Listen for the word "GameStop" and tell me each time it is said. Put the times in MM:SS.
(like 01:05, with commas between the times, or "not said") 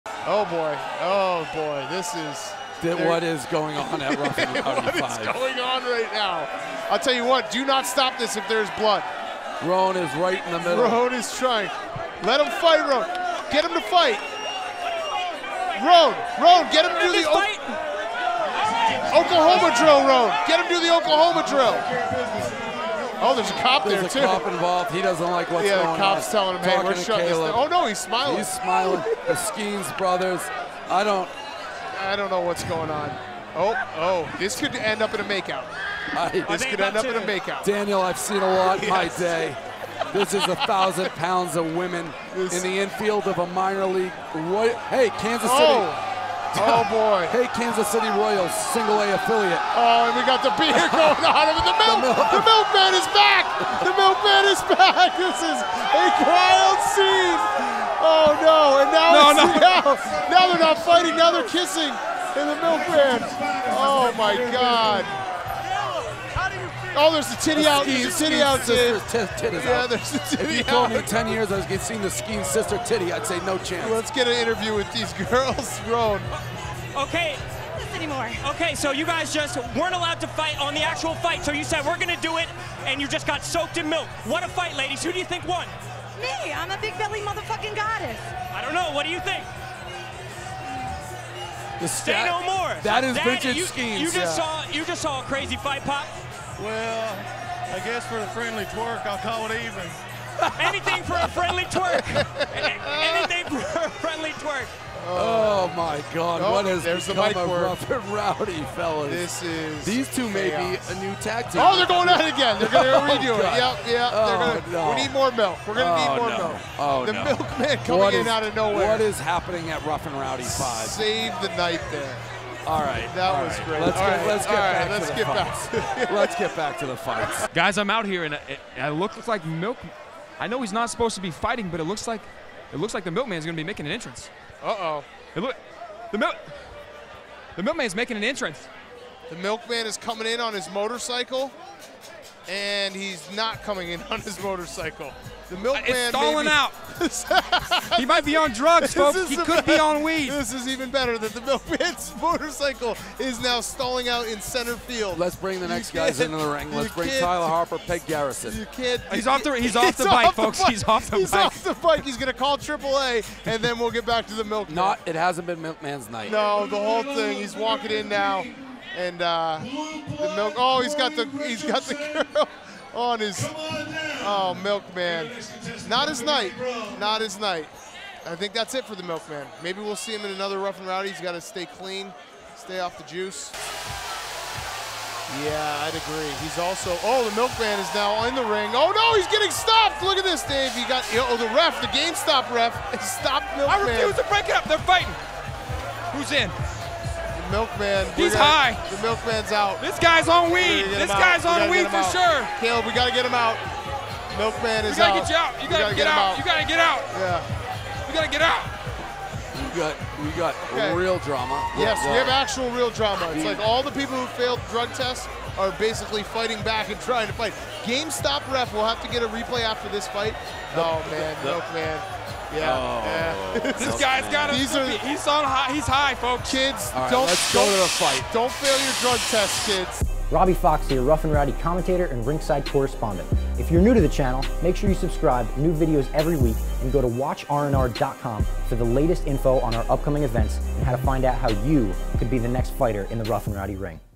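03:11, 03:37.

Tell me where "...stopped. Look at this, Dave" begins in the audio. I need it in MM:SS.
03:09.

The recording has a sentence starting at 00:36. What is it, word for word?
I, this could end up in a makeout.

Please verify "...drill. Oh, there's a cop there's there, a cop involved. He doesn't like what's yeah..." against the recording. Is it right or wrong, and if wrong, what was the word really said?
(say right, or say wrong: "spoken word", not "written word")
right.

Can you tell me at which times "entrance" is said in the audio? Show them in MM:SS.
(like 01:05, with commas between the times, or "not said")
02:13, 02:18.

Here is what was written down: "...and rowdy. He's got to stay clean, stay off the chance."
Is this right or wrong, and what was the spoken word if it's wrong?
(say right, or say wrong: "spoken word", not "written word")
wrong: "juice", not "chance".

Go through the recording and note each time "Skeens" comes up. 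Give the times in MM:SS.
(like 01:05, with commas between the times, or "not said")
00:29, 01:12.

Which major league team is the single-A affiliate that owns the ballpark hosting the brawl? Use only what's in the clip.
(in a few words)
Kansas City Royals.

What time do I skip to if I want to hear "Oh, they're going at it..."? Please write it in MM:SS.
01:51.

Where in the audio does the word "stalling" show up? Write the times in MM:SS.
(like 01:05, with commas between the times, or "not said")
02:25, 02:33.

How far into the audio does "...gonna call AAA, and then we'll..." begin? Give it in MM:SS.
02:42.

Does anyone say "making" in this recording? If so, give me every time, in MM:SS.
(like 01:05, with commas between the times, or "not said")
02:13, 02:17.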